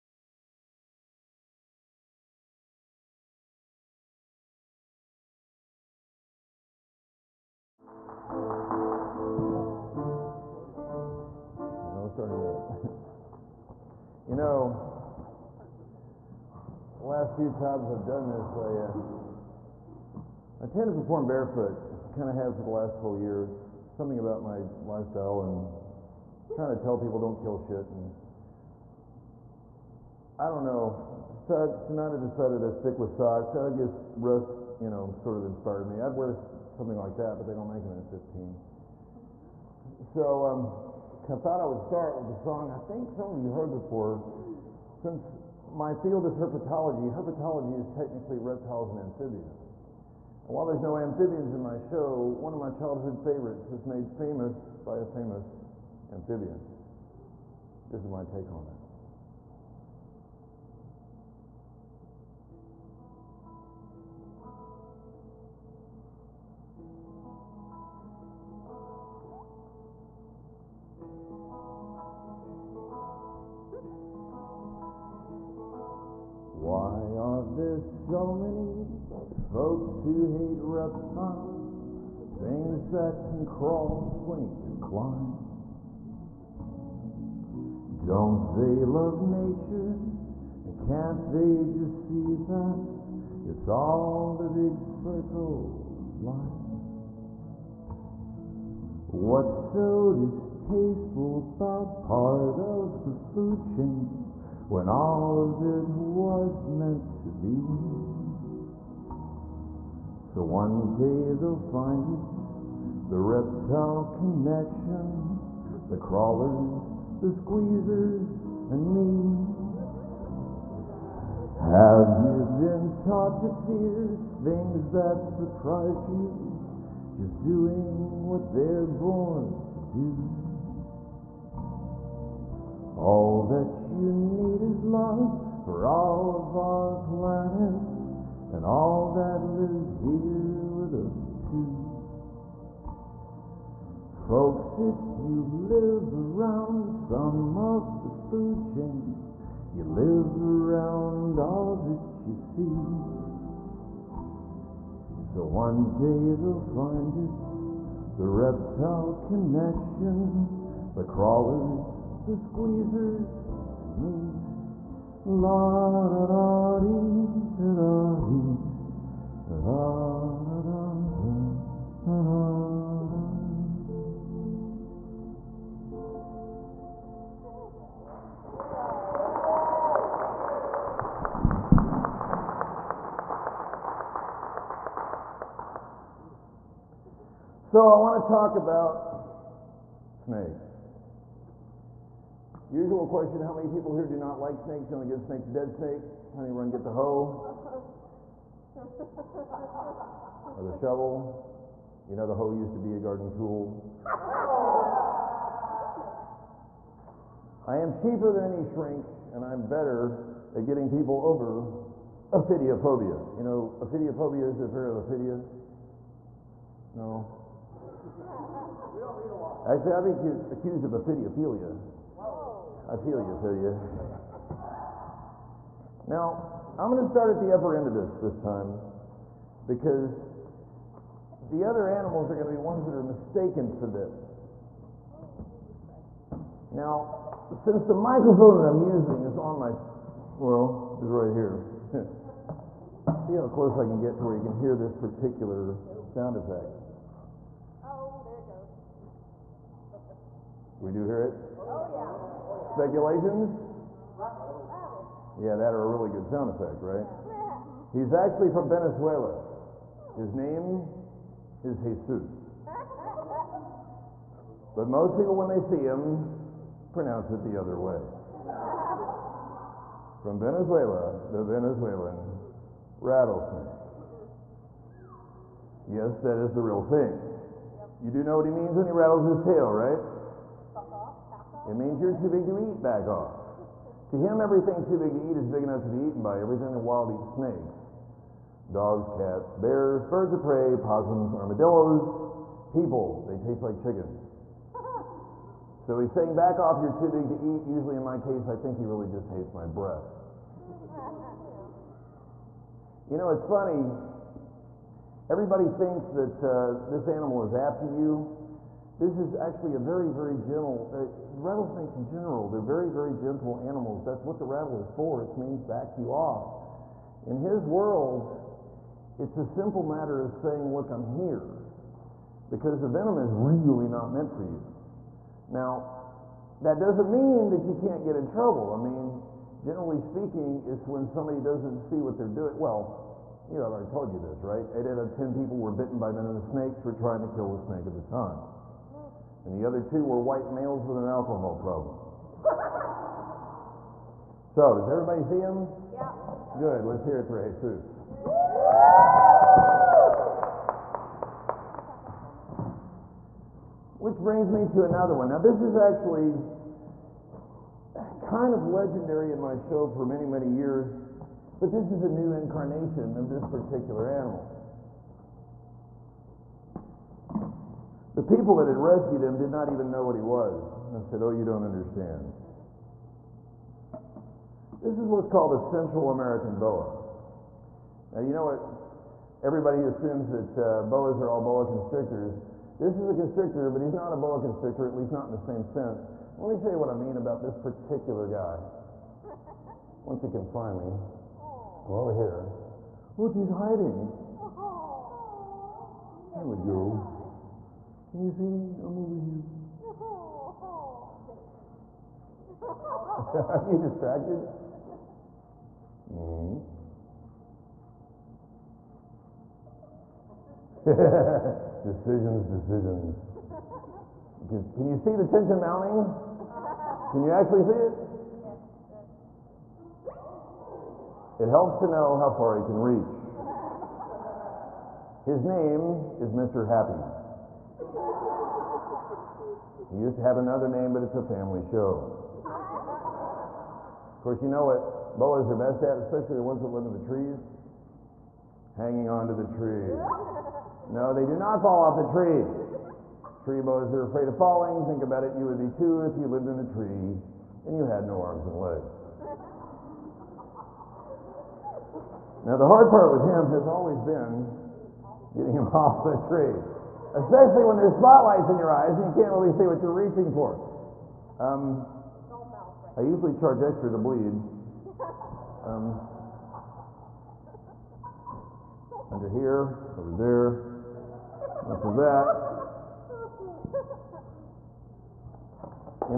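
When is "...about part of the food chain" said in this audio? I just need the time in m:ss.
1:41.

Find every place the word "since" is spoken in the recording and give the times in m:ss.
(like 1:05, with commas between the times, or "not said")
0:44, 3:57.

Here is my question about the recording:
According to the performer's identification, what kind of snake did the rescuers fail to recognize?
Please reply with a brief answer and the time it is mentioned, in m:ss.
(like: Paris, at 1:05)
Central American boa, at 6:15.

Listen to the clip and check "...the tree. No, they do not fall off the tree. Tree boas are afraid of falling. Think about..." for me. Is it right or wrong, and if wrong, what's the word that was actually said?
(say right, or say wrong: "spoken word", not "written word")
right.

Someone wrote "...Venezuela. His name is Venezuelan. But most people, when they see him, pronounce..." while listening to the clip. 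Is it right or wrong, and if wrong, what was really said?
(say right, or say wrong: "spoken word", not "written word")
wrong: "Jesus", not "Venezuelan".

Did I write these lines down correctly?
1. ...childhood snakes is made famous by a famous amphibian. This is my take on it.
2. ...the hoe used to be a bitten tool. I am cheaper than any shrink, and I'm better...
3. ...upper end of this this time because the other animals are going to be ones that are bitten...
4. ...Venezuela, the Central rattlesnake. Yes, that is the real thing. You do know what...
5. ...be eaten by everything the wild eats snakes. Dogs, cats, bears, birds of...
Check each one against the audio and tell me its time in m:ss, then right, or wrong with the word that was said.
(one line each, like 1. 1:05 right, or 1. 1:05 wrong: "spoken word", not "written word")
1. 0:52 wrong: "favorites", not "snakes"
2. 3:22 wrong: "garden", not "bitten"
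3. 3:47 wrong: "mistaken", not "bitten"
4. 4:30 wrong: "Venezuelan", not "Central"
5. 4:45 right.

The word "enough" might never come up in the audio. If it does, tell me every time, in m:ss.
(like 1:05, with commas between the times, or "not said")
4:45.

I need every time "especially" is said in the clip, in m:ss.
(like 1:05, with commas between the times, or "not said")
7:15, 7:37.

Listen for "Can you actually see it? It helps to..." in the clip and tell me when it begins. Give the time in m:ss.
6:57.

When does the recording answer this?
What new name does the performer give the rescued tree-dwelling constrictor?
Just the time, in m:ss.
7:06.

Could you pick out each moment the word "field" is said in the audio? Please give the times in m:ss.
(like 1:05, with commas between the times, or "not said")
0:45.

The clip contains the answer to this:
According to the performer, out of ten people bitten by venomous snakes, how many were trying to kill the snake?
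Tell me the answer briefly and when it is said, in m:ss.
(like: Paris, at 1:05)
8, at 5:34.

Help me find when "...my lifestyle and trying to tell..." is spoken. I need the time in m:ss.
0:24.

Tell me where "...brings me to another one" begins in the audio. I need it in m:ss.
5:54.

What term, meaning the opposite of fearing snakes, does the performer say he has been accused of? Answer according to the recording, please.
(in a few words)
Ophidiophilia.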